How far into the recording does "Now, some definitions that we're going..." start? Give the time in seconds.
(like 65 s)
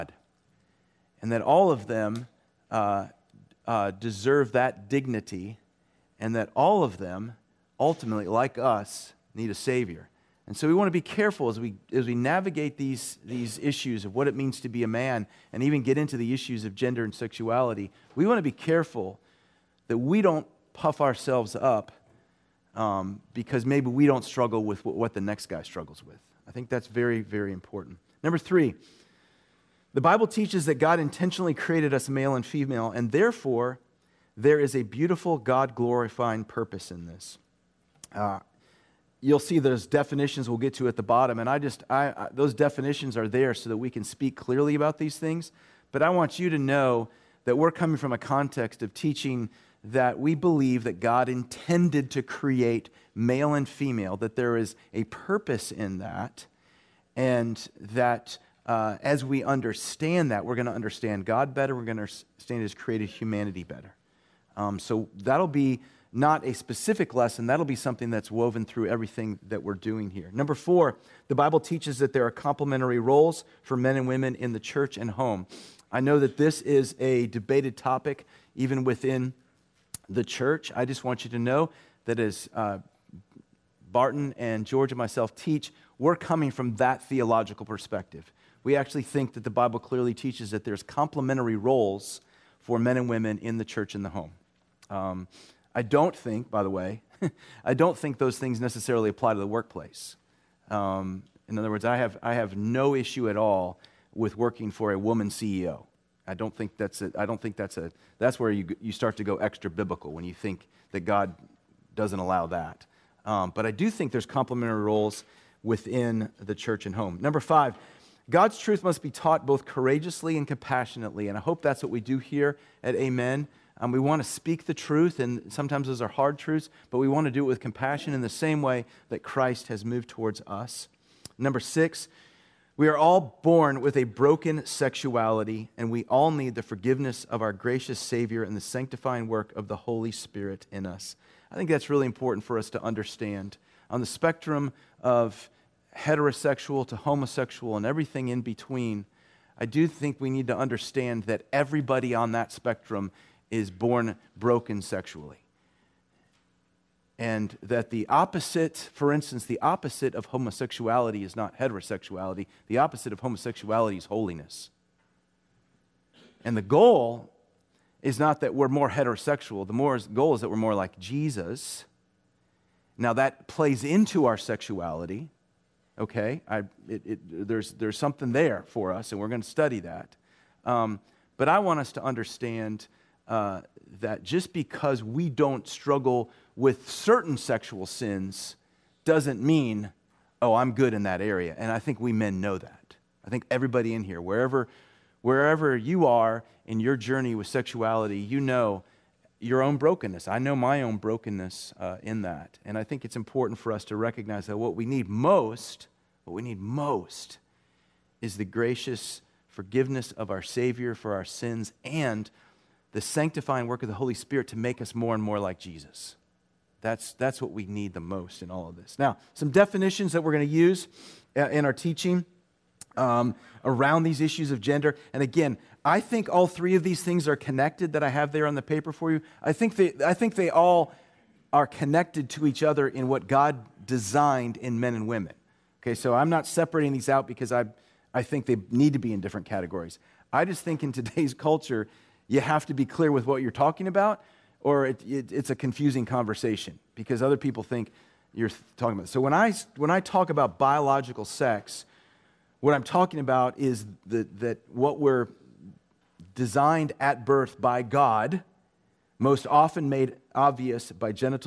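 218 s.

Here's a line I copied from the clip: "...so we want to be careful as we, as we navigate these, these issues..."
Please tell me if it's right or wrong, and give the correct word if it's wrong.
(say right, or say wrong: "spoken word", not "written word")
right.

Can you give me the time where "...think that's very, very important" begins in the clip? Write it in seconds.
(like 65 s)
26 s.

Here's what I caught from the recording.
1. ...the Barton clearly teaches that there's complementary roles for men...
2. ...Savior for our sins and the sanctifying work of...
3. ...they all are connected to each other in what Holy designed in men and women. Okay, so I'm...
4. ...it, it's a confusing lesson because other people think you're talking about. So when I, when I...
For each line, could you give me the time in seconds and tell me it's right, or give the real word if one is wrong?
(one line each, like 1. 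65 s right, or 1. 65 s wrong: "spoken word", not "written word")
1. 89 s wrong: "Bible", not "Barton"
2. 210 s right
3. 230 s wrong: "God", not "Holy"
4. 245 s wrong: "conversation", not "lesson".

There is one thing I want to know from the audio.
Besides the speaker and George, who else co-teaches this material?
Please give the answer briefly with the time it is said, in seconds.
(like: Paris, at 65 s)
Barton, at 83 s.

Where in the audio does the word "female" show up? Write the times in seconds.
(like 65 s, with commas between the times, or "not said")
32 s, 53 s.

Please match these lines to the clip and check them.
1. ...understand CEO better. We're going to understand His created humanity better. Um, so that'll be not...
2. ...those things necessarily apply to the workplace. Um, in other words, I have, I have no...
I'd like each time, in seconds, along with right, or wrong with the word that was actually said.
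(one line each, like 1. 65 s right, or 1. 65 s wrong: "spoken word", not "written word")
1. 60 s wrong: "God", not "CEO"
2. 98 s right.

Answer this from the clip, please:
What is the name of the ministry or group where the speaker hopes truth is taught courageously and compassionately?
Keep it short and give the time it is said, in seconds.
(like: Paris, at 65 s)
Amen, at 122 s.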